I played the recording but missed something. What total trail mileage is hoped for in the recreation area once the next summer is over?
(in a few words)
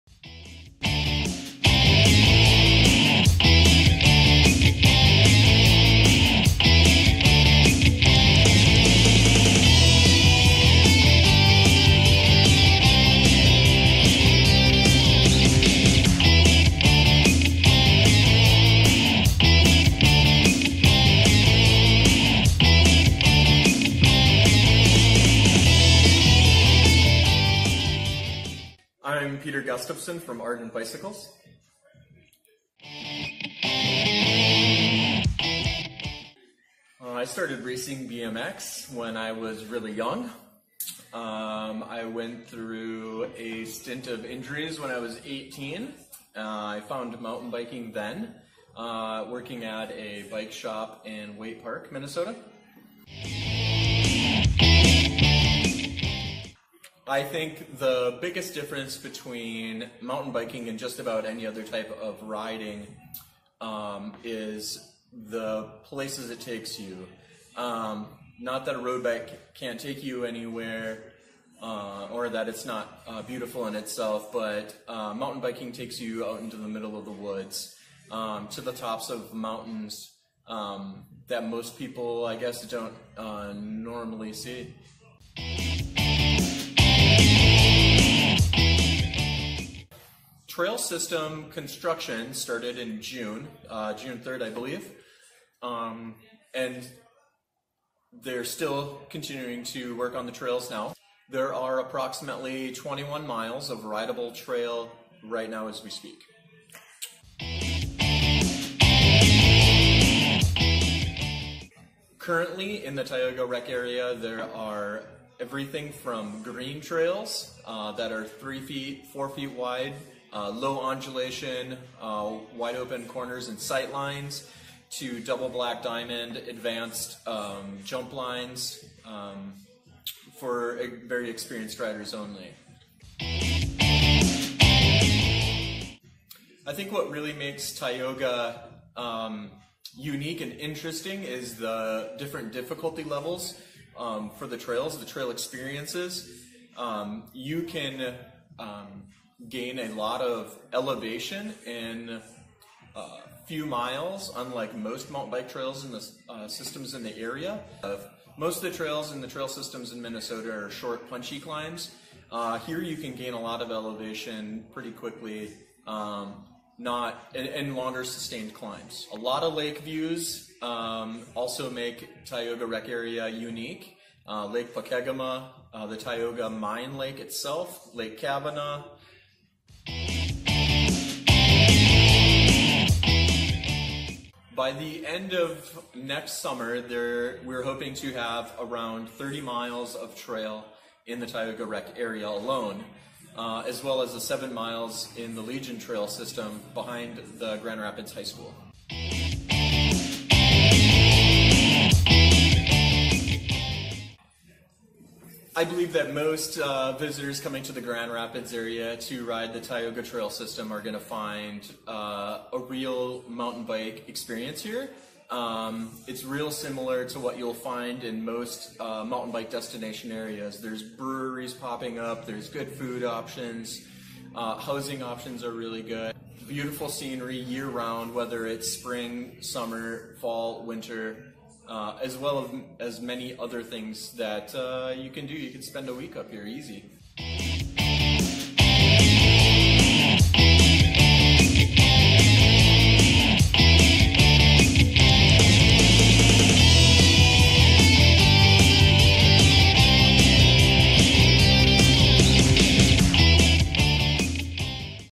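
30 miles.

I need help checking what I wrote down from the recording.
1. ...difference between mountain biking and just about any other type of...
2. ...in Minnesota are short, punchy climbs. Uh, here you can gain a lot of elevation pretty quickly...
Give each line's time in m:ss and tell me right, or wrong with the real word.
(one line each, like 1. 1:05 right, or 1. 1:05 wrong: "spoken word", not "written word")
1. 0:58 right
2. 2:39 right.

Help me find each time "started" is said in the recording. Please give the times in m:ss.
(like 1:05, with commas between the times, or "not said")
0:37, 1:32.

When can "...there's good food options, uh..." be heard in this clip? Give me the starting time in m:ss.
3:42.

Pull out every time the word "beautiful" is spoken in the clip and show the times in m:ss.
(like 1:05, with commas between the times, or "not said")
1:13, 3:46.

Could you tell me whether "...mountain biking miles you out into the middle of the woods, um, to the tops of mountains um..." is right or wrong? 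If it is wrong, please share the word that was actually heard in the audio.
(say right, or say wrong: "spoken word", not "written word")
wrong: "takes", not "miles".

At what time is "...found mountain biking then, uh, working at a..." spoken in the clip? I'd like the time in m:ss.
0:46.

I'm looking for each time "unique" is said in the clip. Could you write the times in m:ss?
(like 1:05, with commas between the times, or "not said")
2:19, 2:53.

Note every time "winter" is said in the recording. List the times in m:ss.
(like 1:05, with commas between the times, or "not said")
3:50.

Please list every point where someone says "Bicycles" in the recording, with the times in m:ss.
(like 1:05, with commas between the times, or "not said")
0:30.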